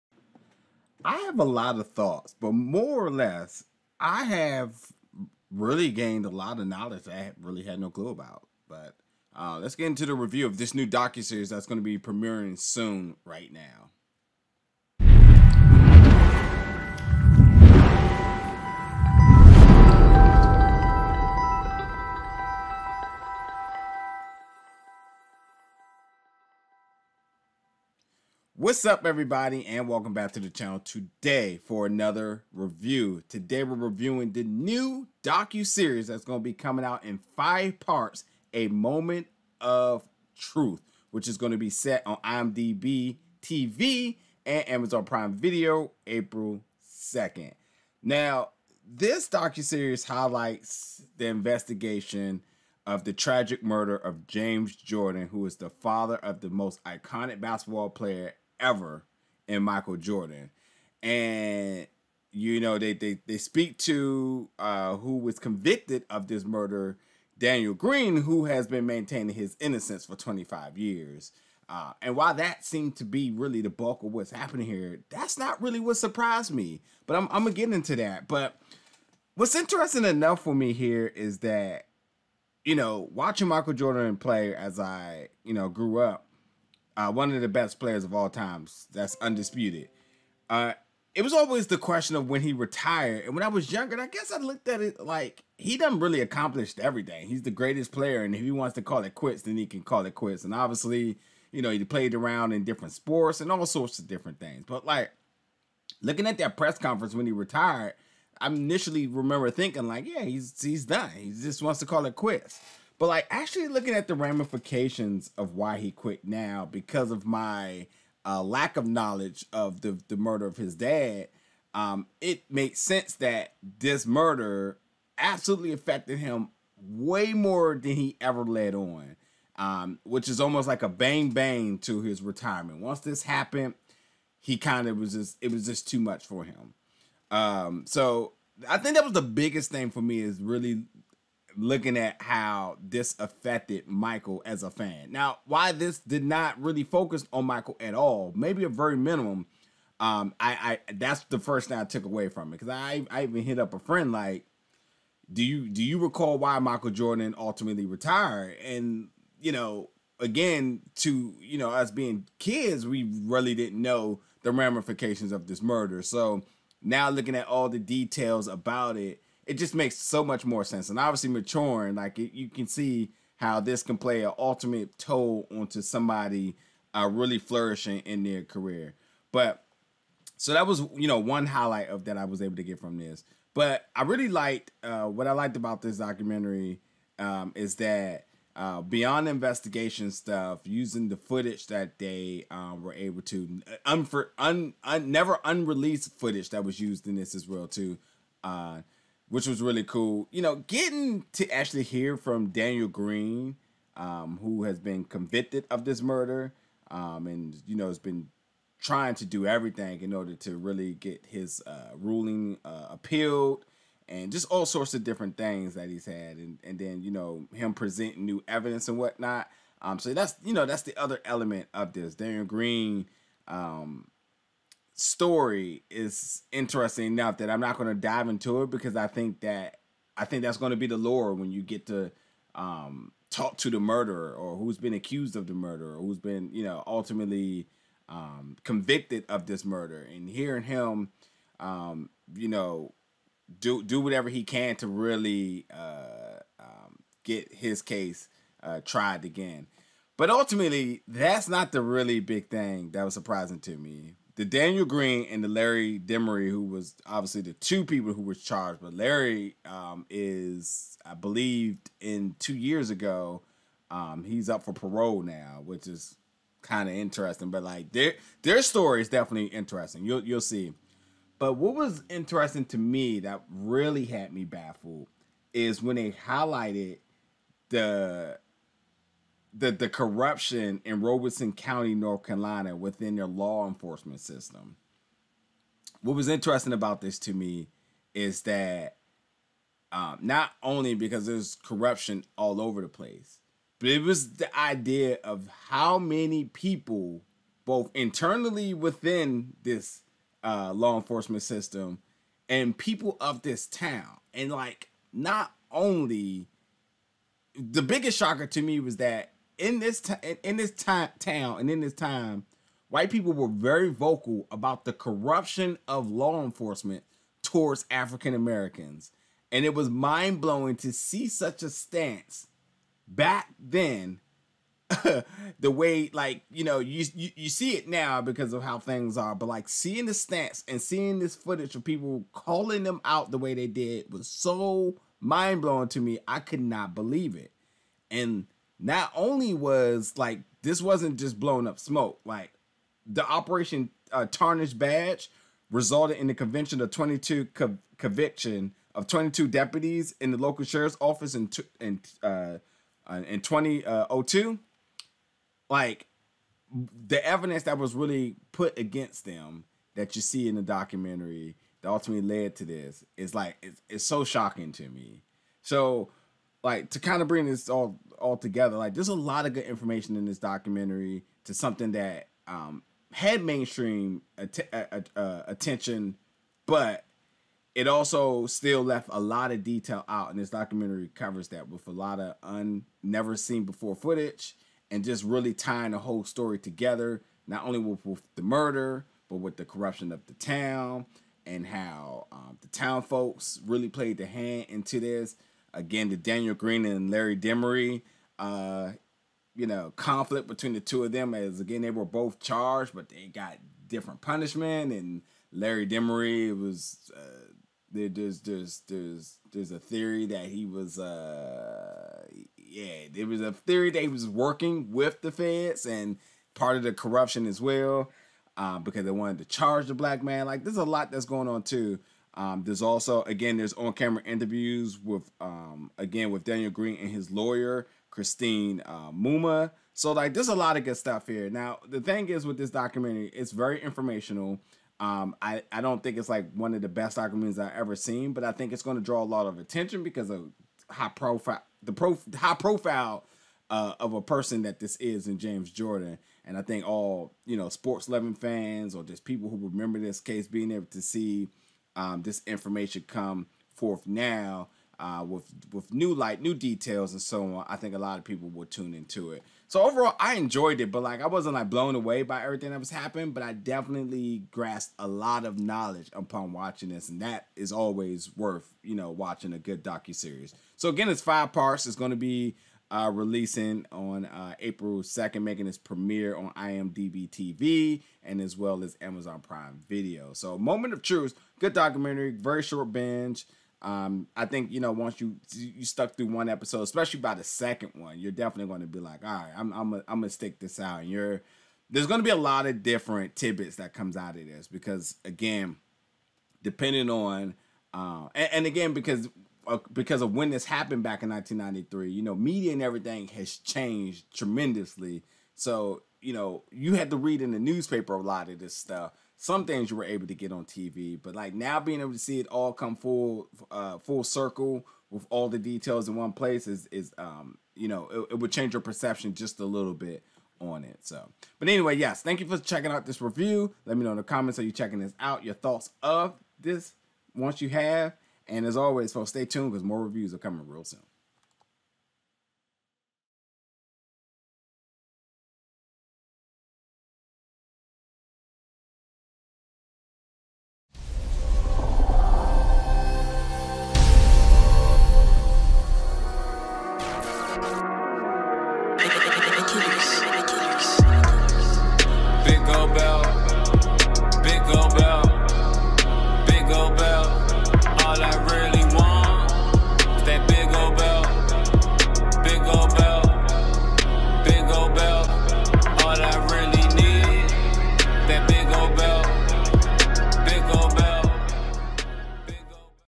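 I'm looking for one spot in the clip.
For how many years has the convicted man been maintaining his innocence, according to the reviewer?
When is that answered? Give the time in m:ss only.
1:10.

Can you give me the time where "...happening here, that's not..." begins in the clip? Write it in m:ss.
1:14.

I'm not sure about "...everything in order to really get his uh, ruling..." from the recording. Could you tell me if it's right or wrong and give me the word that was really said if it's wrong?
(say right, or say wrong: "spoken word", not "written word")
right.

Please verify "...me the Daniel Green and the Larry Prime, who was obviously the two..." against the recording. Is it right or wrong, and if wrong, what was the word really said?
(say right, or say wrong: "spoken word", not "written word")
wrong: "Demery", not "Prime".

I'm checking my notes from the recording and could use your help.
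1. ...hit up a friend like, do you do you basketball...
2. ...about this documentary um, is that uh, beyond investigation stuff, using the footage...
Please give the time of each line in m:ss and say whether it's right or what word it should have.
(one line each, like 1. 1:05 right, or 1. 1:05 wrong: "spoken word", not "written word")
1. 2:33 wrong: "recall", not "basketball"
2. 3:05 right.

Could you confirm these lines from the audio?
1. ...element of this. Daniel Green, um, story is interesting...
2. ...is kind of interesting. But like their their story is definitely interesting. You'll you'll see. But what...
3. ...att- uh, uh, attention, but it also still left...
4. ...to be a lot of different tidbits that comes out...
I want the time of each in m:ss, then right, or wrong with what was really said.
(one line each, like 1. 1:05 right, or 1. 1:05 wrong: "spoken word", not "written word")
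1. 3:41 right
2. 4:25 right
3. 6:14 right
4. 8:12 right.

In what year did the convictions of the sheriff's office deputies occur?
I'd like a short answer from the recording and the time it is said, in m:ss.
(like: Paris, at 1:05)
2002, at 5:53.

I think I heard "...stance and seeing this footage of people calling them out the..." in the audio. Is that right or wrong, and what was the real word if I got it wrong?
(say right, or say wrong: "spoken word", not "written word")
right.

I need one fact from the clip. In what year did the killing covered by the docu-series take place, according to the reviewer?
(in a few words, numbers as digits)
1993.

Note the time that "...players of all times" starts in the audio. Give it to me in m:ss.
1:27.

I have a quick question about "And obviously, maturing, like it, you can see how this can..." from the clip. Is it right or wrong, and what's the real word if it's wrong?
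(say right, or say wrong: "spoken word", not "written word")
right.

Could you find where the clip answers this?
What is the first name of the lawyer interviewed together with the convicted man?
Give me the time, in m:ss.
7:08.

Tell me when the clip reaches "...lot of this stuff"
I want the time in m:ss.
8:28.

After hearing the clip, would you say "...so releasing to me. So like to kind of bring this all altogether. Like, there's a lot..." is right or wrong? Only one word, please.
wrong.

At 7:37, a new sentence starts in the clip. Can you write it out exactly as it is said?
I think a lot of people will tune into it.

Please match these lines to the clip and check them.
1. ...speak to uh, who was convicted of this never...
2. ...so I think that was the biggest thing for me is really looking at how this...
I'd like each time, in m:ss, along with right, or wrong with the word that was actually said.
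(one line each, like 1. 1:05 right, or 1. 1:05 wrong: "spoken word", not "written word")
1. 1:03 wrong: "murder", not "never"
2. 2:17 right.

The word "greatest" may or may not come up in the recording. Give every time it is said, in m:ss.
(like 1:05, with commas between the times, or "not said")
1:37.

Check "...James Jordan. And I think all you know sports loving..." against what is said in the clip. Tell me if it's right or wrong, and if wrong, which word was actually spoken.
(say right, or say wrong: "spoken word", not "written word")
right.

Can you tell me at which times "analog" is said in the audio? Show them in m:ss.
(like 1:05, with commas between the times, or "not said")
not said.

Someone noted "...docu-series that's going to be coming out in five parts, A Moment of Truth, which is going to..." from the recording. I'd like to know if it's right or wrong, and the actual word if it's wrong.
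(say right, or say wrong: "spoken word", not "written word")
right.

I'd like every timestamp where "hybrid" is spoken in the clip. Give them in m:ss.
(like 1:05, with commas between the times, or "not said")
not said.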